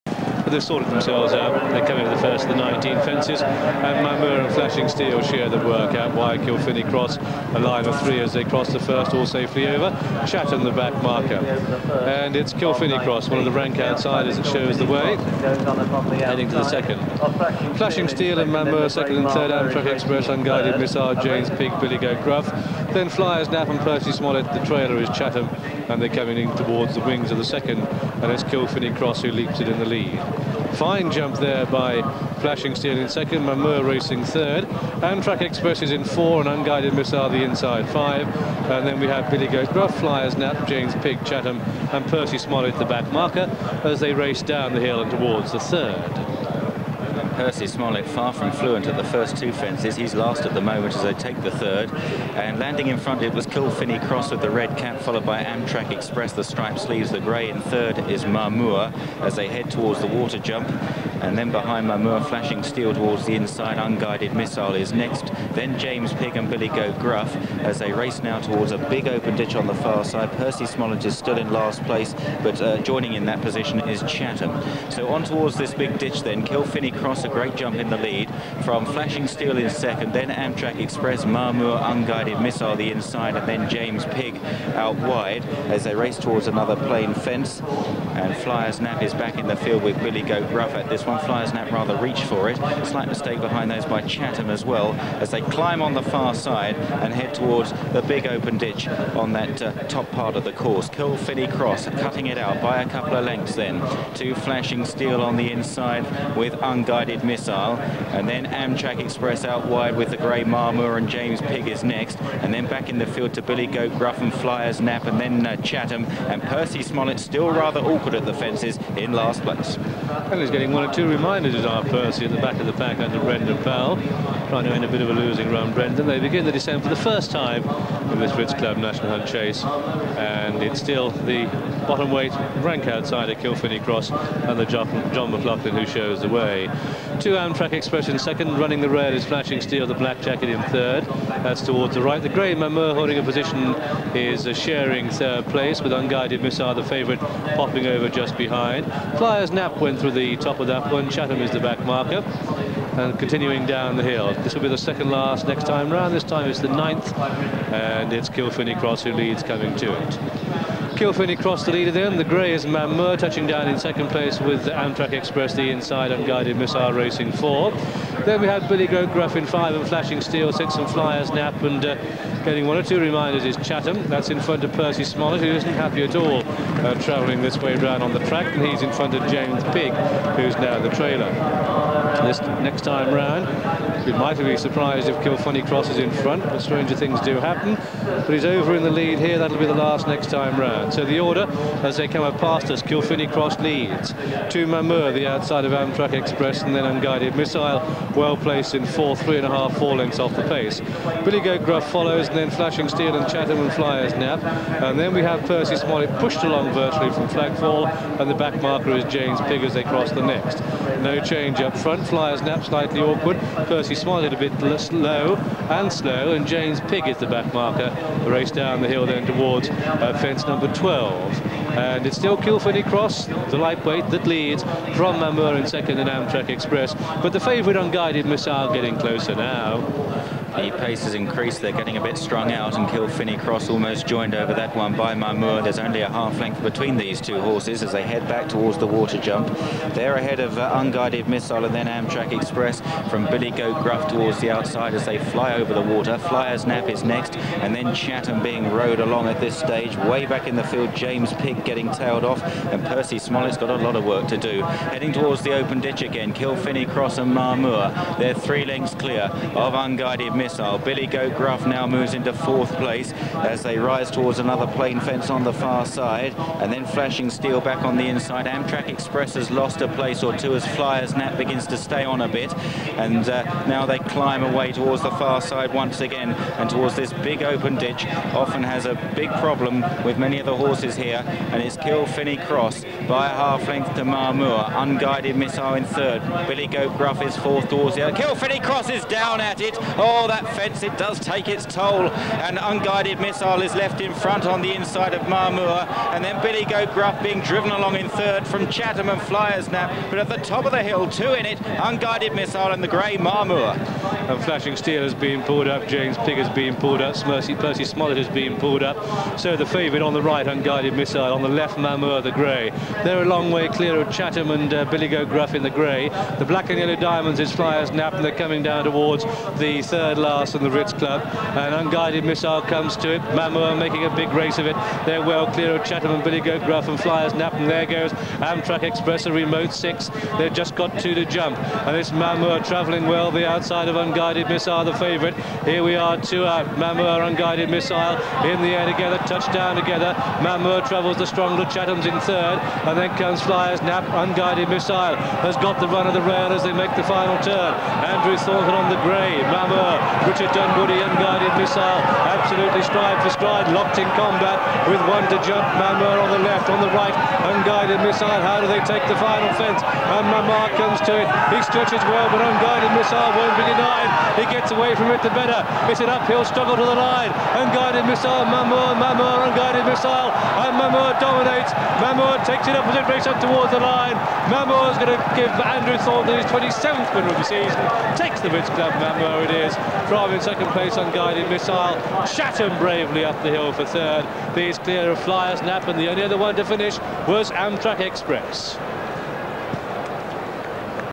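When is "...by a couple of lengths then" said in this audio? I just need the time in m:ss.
1:42.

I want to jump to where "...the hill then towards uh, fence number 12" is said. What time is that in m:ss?
3:38.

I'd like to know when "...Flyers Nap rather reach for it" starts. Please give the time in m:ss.
1:31.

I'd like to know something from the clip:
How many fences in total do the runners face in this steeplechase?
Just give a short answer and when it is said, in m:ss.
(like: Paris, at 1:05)
19, at 0:02.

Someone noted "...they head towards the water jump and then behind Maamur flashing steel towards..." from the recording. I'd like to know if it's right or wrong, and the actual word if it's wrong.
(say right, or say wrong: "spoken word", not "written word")
right.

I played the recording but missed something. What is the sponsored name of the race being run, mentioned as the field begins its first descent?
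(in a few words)
Ritz Club National Hunt Chase.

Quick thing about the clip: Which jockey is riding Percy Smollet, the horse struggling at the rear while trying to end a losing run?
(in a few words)
Brendan Powell.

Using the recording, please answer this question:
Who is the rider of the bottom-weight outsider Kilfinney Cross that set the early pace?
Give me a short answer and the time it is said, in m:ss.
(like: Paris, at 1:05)
John McLaughlin, at 2:15.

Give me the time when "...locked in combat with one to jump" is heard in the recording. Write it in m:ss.
5:53.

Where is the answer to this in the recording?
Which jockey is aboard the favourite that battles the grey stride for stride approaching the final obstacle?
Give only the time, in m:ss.
5:50.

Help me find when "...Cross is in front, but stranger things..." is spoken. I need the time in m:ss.
3:05.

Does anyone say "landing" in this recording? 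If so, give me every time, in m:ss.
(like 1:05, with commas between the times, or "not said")
0:52.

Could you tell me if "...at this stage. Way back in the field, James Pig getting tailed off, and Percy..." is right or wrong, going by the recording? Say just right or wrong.
right.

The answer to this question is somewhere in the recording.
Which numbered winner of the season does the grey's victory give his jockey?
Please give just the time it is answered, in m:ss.
6:16.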